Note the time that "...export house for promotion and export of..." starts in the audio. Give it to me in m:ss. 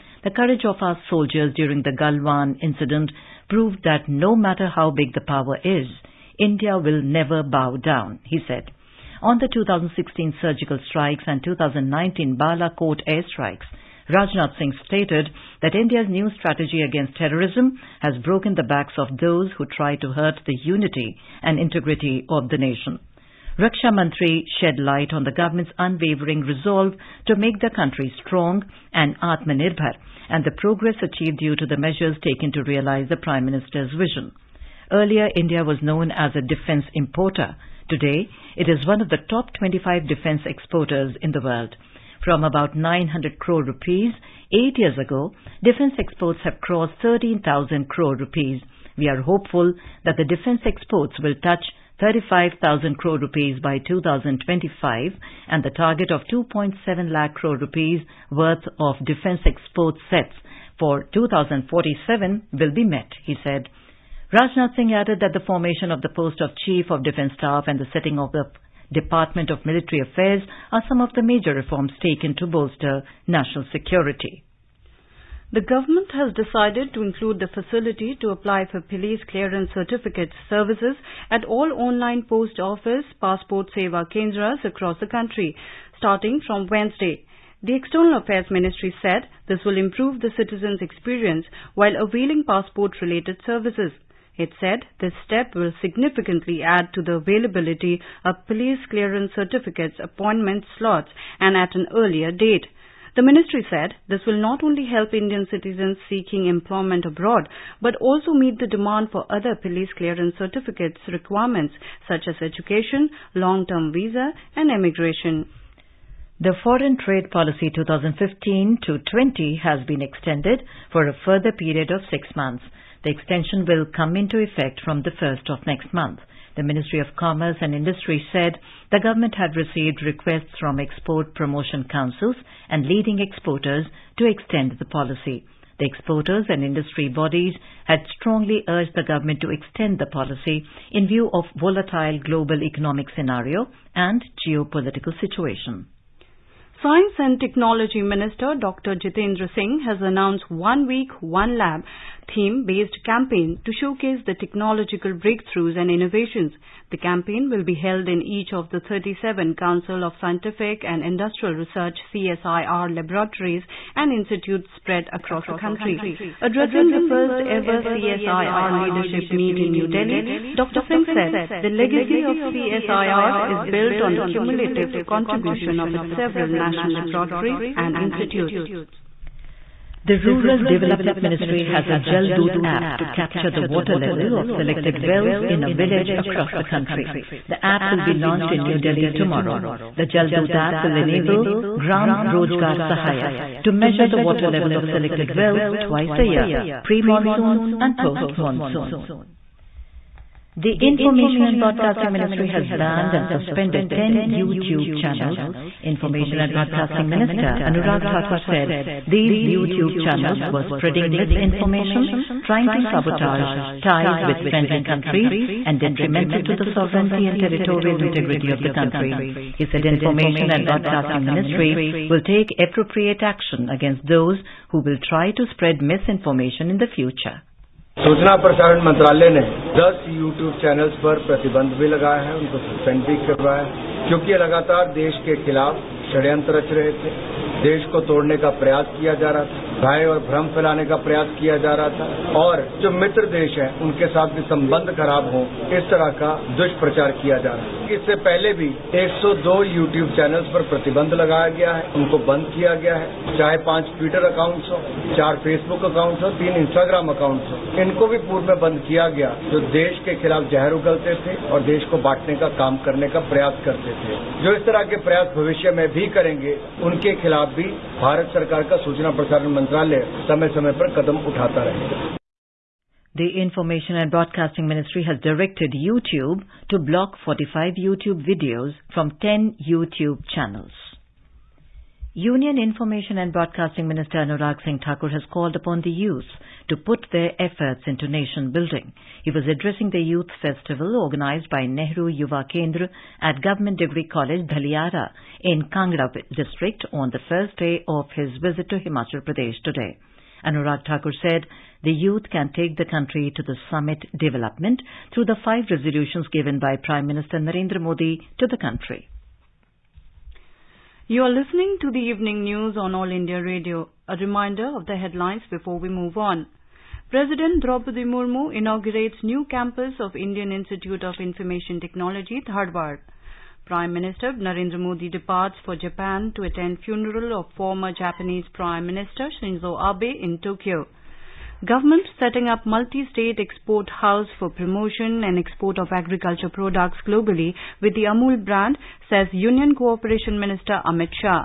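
5:33.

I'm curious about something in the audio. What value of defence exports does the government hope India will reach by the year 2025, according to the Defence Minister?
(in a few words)
35,000 crore rupees.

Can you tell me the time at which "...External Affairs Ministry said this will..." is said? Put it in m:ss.
1:27.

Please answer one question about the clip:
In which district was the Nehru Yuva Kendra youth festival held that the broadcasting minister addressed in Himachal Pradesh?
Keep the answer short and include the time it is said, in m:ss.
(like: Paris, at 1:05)
Kangra, at 4:55.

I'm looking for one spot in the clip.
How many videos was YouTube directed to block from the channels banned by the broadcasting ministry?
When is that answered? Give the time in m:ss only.
4:37.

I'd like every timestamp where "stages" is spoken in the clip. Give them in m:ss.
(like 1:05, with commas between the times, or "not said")
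not said.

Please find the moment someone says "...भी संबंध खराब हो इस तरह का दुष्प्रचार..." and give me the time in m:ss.
4:04.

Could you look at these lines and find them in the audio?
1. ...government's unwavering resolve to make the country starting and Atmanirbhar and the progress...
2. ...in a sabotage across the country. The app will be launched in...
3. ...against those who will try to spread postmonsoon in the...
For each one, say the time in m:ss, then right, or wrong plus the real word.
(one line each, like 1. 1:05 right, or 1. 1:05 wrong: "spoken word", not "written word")
1. 0:25 wrong: "strong", not "starting"
2. 3:05 wrong: "village", not "sabotage"
3. 3:43 wrong: "misinformation", not "postmonsoon".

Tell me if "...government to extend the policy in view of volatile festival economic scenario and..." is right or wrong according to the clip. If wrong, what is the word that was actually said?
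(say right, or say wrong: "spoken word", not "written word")
wrong: "global", not "festival".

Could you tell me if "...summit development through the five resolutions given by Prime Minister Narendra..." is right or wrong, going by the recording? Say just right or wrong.
right.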